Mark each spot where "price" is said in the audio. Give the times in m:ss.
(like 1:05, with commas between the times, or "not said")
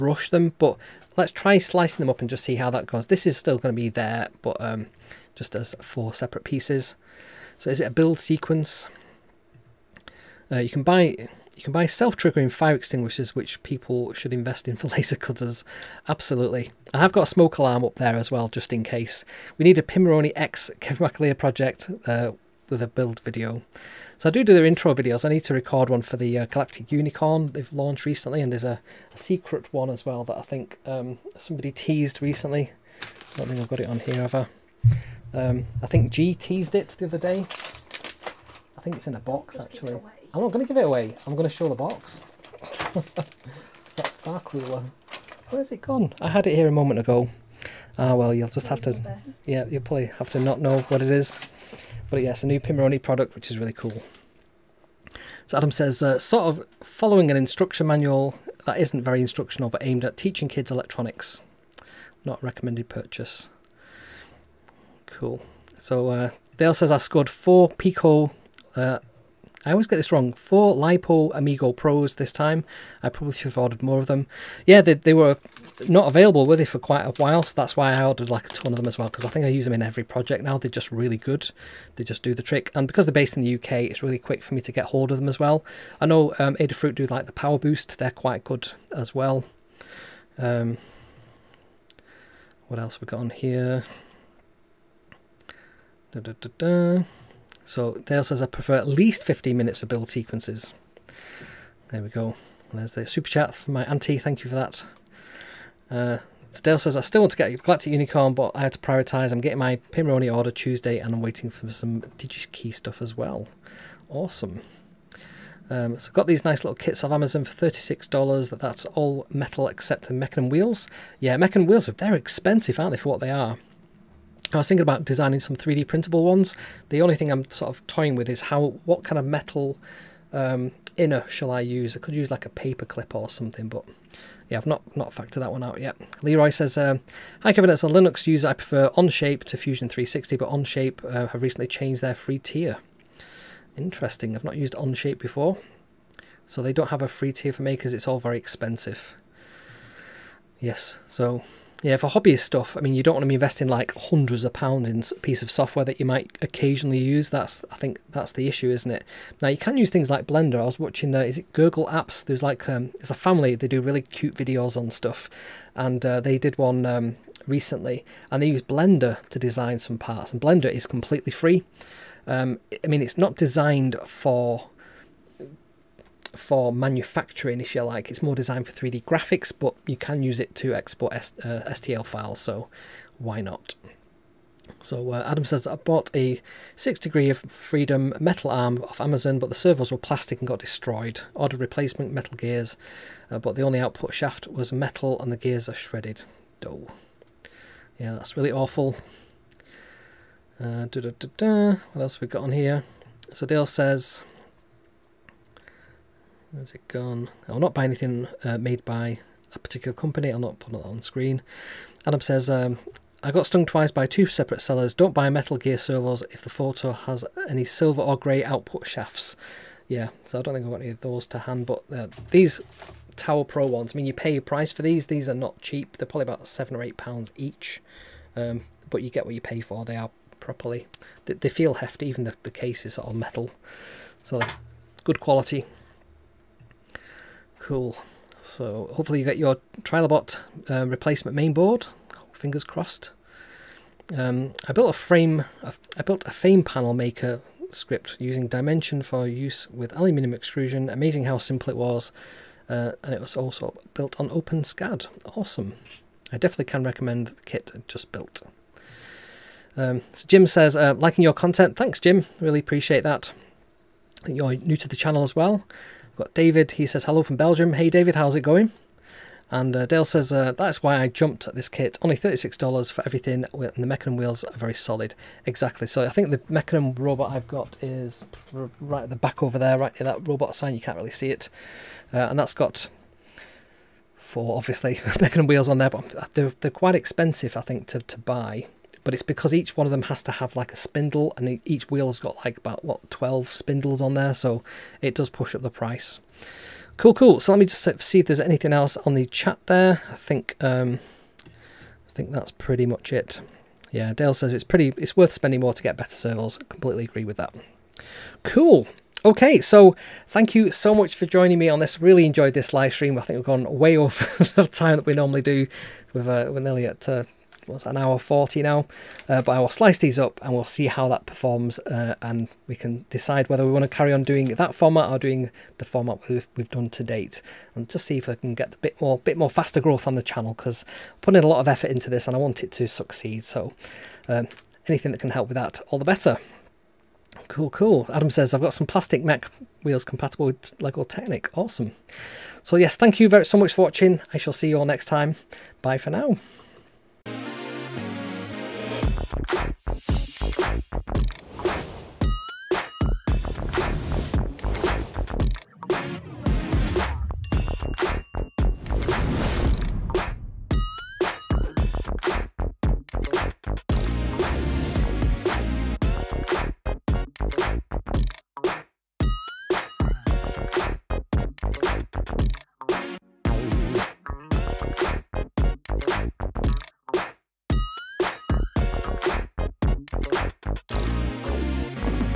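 3:44, 4:55.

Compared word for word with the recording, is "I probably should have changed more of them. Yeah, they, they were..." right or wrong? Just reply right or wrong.
wrong.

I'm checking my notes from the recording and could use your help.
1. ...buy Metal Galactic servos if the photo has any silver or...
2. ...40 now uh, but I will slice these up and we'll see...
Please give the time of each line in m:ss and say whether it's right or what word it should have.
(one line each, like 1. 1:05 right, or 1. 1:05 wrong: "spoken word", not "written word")
1. 3:35 wrong: "Gear", not "Galactic"
2. 5:18 right.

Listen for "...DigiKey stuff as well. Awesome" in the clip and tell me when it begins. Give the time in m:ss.
1:52.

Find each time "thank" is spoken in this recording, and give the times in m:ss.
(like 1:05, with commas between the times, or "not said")
1:44, 4:21, 5:10, 5:42.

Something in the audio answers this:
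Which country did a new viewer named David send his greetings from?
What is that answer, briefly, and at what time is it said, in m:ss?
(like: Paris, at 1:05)
Belgium, at 4:27.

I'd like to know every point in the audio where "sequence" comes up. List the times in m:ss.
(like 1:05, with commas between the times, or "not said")
0:08, 1:40.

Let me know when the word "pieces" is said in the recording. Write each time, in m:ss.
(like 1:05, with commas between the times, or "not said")
0:06, 2:35.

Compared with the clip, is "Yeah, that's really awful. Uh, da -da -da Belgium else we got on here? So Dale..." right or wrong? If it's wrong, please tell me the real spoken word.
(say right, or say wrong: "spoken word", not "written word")
wrong: "What", not "Belgium".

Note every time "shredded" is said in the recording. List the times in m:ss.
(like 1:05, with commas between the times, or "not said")
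3:15.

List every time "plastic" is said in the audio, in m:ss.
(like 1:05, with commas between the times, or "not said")
3:09, 5:38.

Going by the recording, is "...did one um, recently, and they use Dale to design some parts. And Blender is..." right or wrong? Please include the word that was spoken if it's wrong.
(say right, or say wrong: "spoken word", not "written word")
wrong: "Blender", not "Dale".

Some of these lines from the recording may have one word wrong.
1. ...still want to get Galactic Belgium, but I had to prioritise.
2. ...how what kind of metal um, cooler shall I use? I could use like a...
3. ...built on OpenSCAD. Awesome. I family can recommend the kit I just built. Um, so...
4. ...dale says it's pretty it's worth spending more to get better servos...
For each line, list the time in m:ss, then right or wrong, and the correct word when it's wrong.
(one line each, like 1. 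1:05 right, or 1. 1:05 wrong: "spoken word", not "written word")
1. 1:46 wrong: "Unicorn", not "Belgium"
2. 2:08 wrong: "inner", not "cooler"
3. 4:13 wrong: "definitely", not "family"
4. 5:04 right.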